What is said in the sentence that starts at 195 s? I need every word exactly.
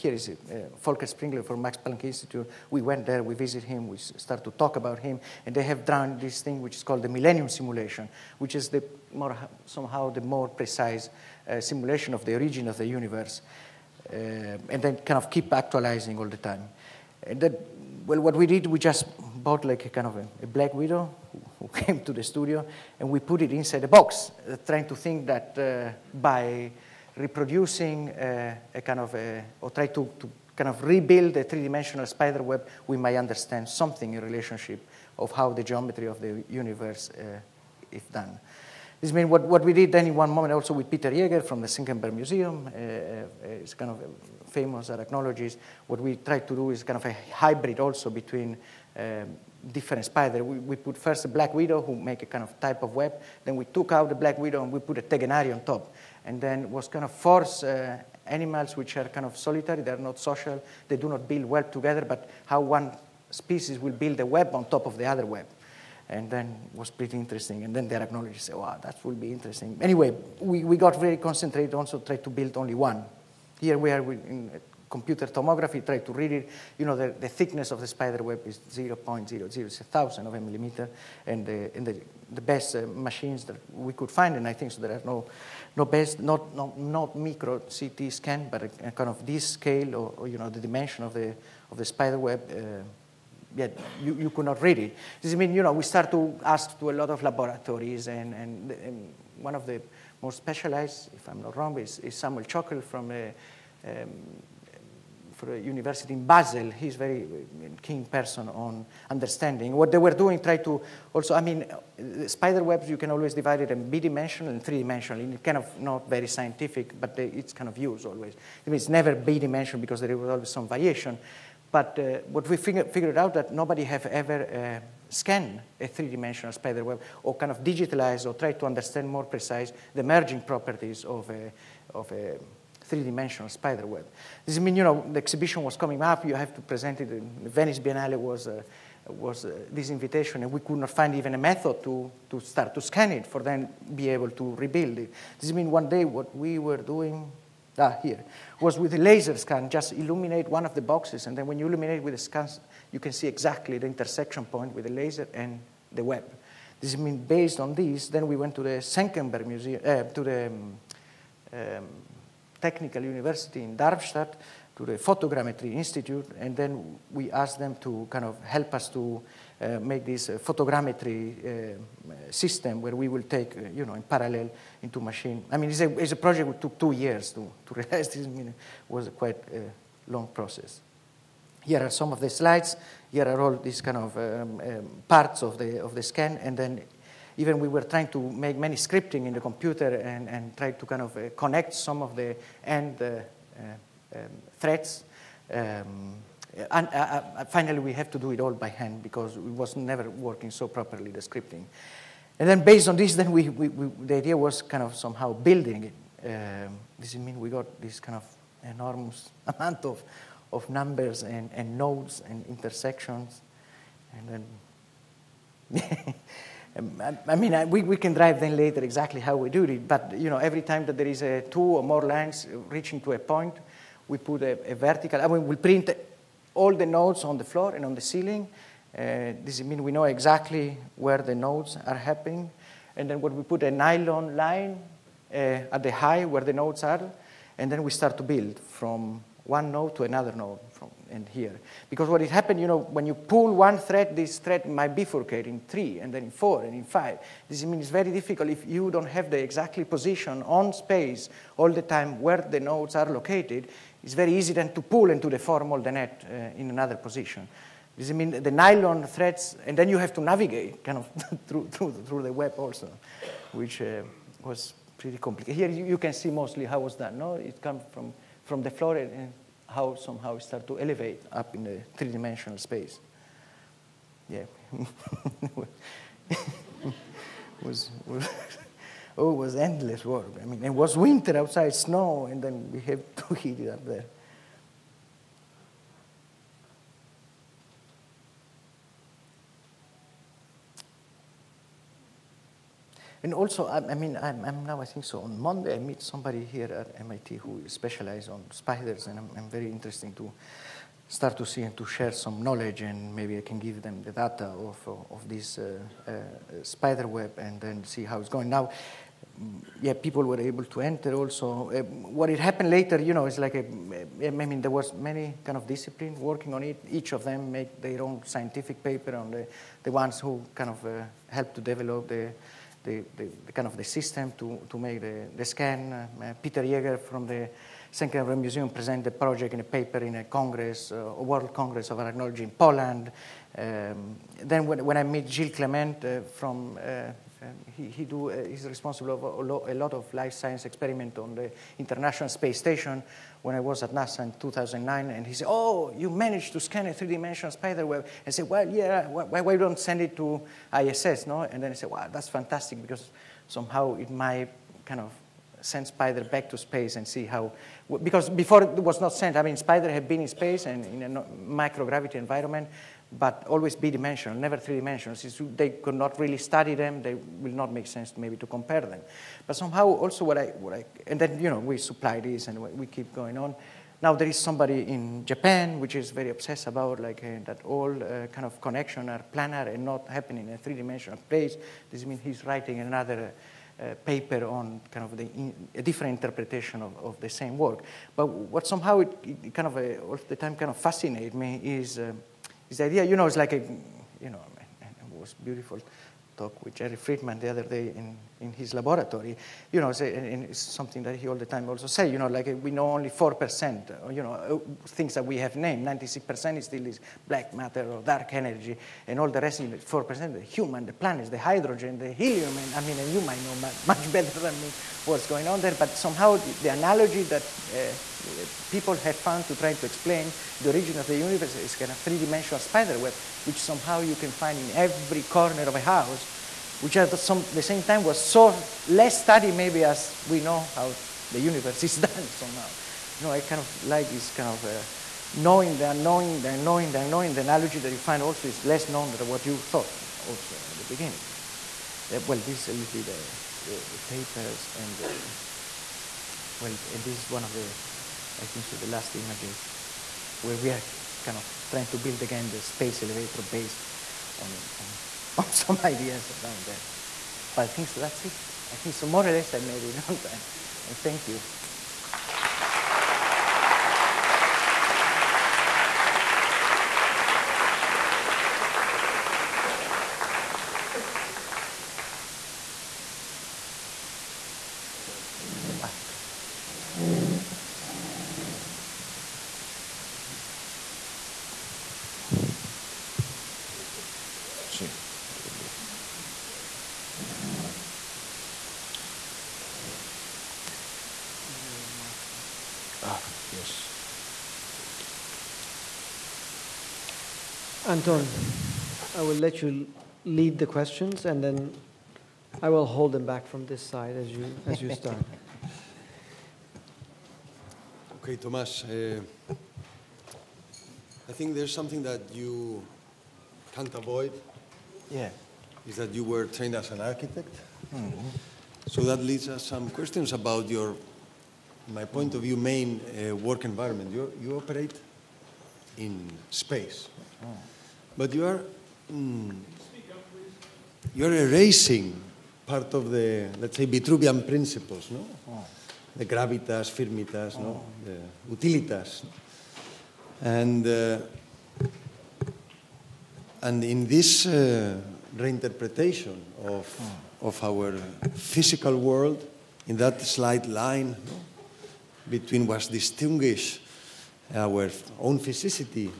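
Um, and uh, uh, finally, we have to do it all by hand because it was never working so properly, the scripting.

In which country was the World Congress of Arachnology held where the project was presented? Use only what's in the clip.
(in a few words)
Poland.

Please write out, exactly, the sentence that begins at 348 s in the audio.
I said, well, yeah, why, why don't send it to ISS, no?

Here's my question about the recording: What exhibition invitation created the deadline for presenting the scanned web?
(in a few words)
Venice Biennale.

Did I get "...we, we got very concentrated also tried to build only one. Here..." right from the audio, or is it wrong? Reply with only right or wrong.
right.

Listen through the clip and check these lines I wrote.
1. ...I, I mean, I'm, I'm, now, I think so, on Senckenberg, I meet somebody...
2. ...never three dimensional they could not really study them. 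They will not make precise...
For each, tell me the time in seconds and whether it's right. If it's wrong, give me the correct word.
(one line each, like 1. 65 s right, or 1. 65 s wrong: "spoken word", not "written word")
1. 293 s wrong: "Monday", not "Senckenberg"
2. 364 s wrong: "sense", not "precise".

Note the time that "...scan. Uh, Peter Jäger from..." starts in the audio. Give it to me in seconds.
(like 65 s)
325 s.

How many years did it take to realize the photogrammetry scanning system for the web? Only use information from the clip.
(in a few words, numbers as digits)
2.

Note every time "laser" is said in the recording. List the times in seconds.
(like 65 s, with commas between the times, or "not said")
148 s, 154 s.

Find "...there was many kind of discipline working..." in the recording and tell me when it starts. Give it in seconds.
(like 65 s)
314 s.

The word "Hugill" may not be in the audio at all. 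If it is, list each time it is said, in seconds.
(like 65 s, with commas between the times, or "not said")
not said.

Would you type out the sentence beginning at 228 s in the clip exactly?
Uh, this means we know exactly where the nodes are happening.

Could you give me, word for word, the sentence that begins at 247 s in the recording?
This means it's very difficult if you don't have the exactly position on space all the time where the nodes are located.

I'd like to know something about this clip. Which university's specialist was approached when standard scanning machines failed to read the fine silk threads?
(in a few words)
University in Basel.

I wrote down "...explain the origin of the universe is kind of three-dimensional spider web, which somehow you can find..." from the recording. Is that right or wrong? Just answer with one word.
right.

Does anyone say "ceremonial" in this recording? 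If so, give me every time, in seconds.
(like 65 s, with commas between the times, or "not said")
not said.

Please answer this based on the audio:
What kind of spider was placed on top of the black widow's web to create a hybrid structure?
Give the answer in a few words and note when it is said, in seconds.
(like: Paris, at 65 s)
Tegenaria, at 55 s.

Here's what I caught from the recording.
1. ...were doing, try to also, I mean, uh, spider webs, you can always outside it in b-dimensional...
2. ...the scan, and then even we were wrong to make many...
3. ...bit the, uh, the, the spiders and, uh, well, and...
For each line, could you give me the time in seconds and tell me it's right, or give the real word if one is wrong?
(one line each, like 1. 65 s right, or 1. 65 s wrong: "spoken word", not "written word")
1. 109 s wrong: "divide", not "outside"
2. 185 s wrong: "trying", not "wrong"
3. 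442 s wrong: "papers", not "spiders".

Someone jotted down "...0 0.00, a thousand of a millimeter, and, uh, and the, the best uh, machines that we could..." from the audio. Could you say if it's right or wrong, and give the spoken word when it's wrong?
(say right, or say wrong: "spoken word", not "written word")
right.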